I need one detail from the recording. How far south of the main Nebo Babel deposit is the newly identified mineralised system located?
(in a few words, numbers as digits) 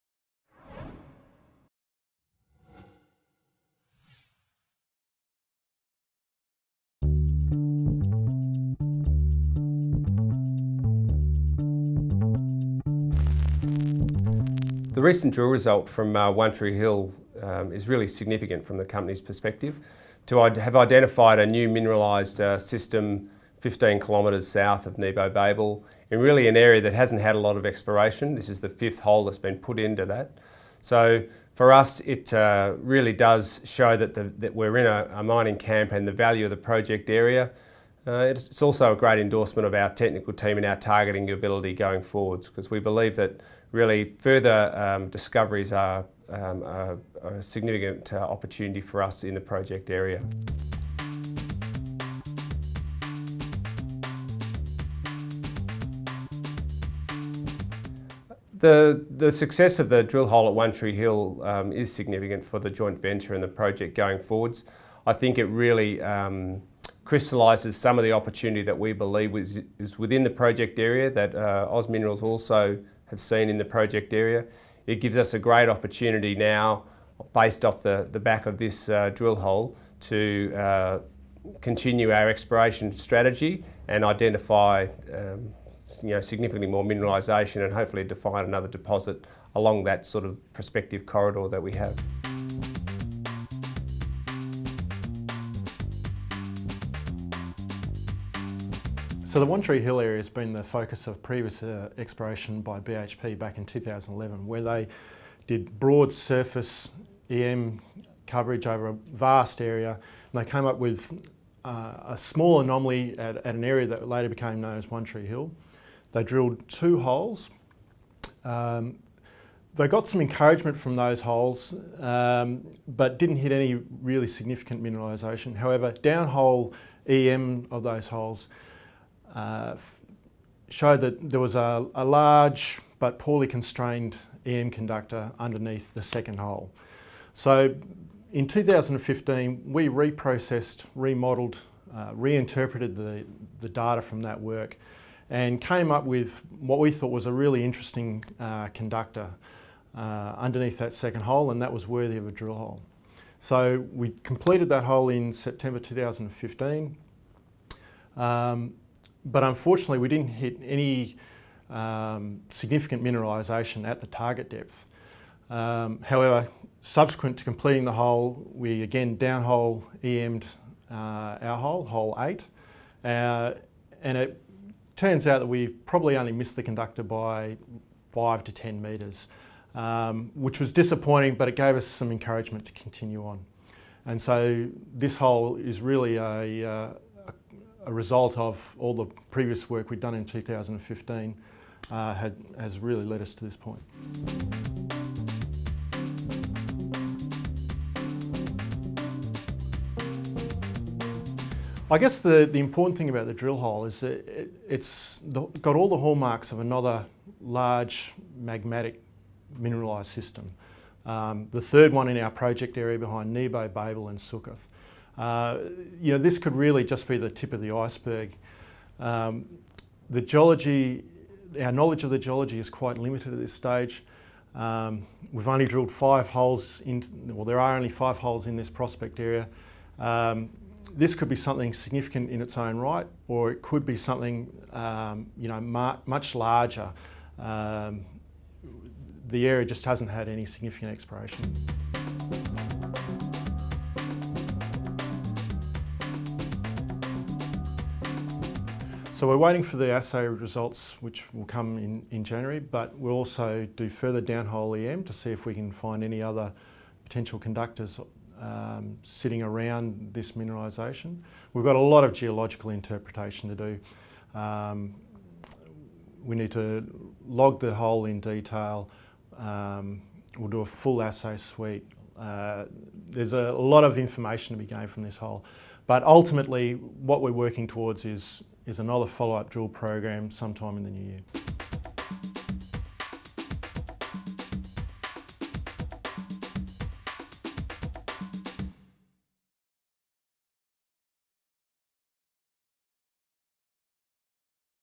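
15 kilometres.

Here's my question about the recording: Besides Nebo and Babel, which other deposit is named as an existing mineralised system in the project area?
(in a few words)
Succoth.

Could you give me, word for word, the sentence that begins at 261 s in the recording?
We've got a lot of geological interpretation to do.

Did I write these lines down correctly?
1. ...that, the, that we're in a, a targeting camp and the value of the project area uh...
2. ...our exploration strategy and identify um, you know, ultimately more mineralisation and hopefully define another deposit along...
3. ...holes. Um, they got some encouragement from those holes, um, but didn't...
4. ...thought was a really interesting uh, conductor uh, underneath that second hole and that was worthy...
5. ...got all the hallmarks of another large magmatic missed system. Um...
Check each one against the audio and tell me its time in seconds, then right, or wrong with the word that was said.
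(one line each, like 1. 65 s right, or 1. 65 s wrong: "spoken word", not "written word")
1. 33 s wrong: "mining", not "targeting"
2. 82 s wrong: "significantly", not "ultimately"
3. 116 s right
4. 146 s right
5. 205 s wrong: "mineralised", not "missed".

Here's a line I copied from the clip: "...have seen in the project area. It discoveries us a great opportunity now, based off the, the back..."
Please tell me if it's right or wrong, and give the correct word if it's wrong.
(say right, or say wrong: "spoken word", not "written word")
wrong: "gives", not "discoveries".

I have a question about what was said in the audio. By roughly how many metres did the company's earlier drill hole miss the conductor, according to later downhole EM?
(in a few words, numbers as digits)
5 to 10 metres.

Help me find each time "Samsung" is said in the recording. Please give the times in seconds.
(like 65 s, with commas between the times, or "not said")
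not said.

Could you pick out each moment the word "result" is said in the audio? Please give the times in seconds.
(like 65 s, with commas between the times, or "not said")
15 s, 187 s, 250 s.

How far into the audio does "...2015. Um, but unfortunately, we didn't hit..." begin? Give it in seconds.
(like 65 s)
155 s.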